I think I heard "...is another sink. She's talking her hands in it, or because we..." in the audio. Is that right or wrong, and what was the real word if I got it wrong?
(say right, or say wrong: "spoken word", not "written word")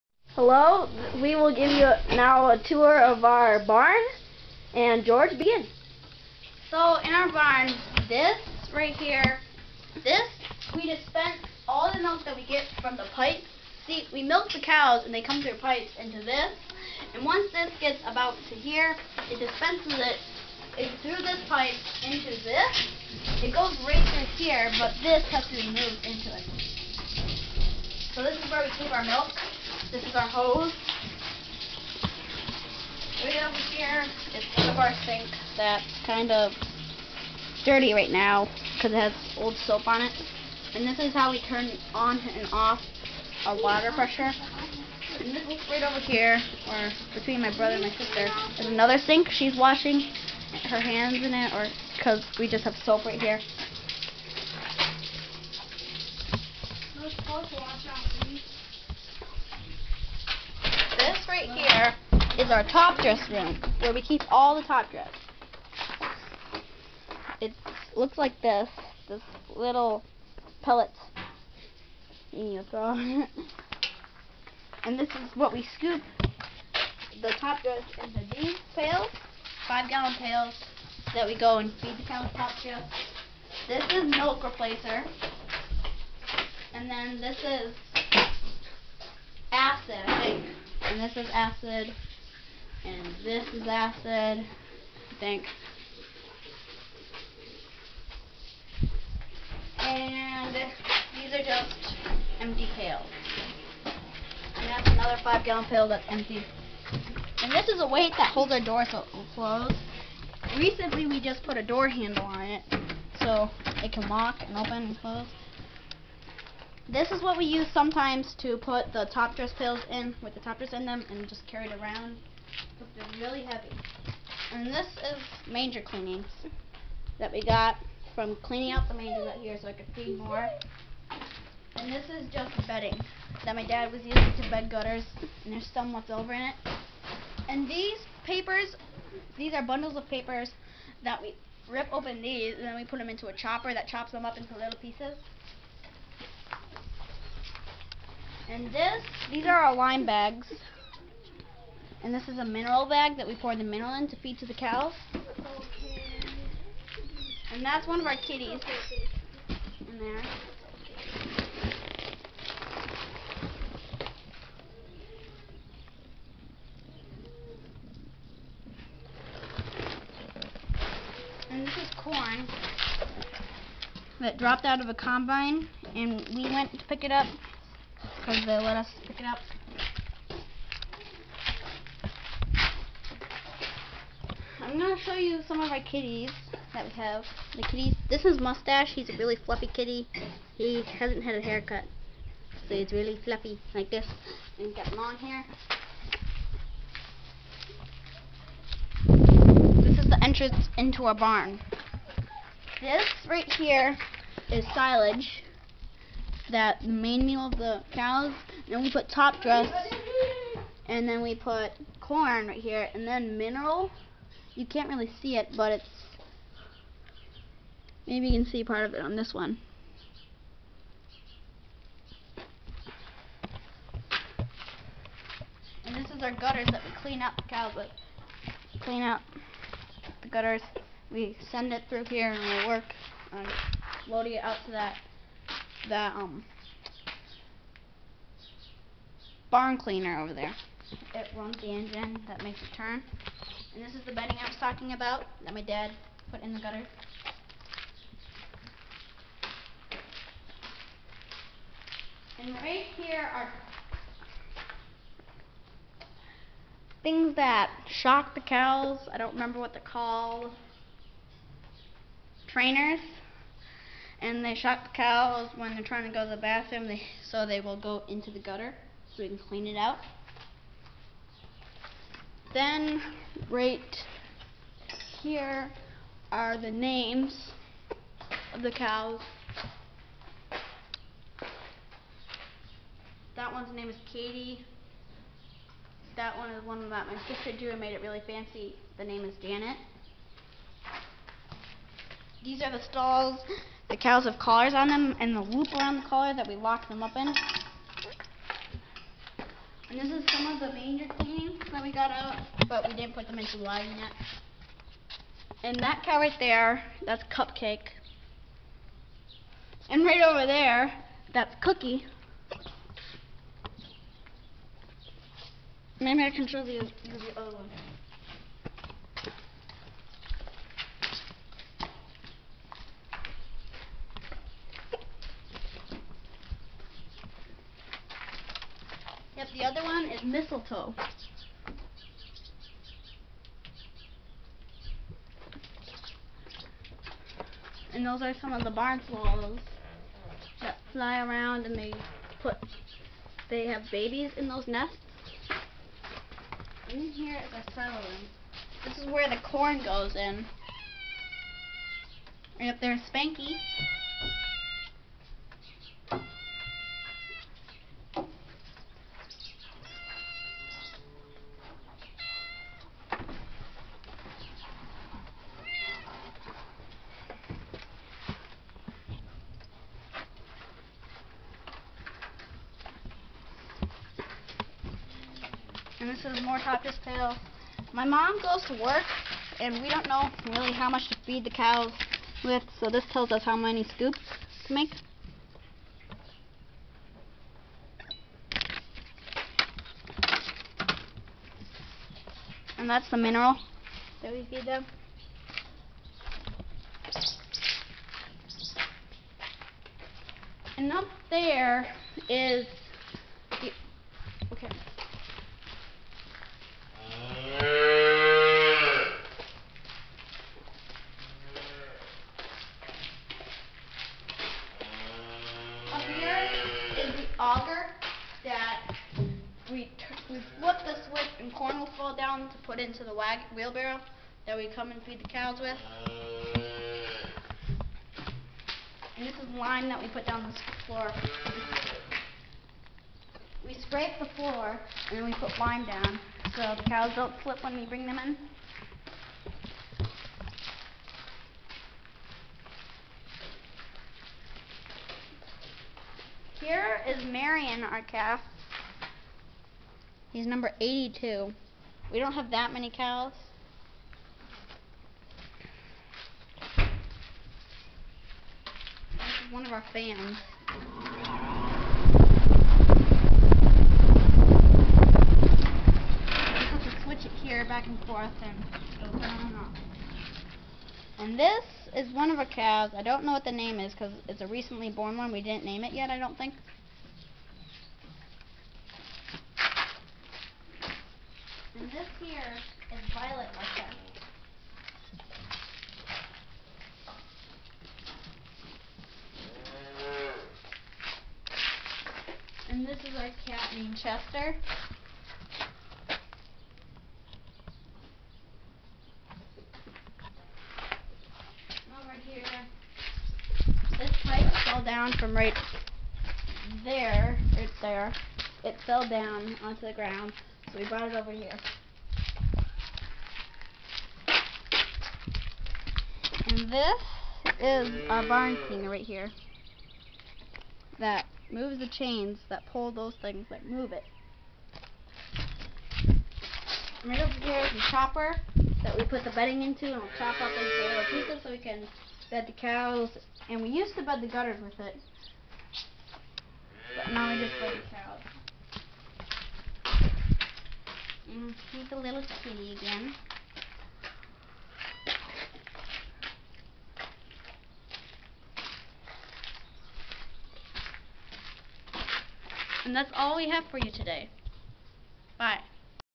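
wrong: "washing", not "talking".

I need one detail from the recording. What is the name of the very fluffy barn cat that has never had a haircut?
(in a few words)
Mustache.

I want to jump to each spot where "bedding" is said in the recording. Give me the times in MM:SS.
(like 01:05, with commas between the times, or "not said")
02:12, 04:04, 08:49.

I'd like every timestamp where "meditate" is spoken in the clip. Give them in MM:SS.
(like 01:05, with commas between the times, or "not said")
not said.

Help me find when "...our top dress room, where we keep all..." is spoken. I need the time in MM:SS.
01:02.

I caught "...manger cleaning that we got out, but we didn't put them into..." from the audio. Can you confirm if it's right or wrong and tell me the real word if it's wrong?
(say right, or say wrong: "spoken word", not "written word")
right.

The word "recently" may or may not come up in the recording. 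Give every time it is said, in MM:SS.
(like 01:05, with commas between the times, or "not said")
01:50, 07:54.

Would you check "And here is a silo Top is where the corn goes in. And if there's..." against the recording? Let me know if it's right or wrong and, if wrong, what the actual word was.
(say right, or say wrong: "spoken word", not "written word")
wrong: "This", not "Top".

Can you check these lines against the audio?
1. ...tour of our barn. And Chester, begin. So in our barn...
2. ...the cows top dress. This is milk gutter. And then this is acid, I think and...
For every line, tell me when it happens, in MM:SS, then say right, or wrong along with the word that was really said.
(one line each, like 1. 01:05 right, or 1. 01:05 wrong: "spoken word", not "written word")
1. 00:02 wrong: "George", not "Chester"
2. 01:21 wrong: "replacer", not "gutter".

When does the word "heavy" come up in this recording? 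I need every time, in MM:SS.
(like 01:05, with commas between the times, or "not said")
02:03.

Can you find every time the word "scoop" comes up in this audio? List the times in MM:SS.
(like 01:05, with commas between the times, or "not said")
01:15, 06:23.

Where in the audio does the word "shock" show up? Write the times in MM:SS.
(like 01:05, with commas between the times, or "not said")
04:17, 04:24.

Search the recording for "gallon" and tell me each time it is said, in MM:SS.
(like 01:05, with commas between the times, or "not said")
01:19, 01:45.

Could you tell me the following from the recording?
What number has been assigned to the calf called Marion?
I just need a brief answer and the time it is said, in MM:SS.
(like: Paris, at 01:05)
82, at 07:30.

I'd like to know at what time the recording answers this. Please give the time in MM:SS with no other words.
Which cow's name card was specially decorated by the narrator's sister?
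04:49.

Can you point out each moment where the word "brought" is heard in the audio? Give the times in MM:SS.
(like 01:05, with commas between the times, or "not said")
08:30.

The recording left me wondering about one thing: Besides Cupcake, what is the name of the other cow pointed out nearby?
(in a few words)
Cookie.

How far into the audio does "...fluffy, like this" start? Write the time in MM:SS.
03:13.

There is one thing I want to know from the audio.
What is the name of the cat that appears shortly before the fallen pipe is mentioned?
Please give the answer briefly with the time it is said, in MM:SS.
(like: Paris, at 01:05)
Chester, at 08:13.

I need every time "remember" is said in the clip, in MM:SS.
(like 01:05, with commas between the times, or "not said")
04:19.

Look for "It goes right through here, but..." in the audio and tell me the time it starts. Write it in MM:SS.
00:23.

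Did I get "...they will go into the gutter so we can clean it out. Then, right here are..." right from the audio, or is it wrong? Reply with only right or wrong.
right.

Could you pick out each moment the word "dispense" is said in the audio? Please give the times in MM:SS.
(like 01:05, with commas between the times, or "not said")
00:10, 00:19.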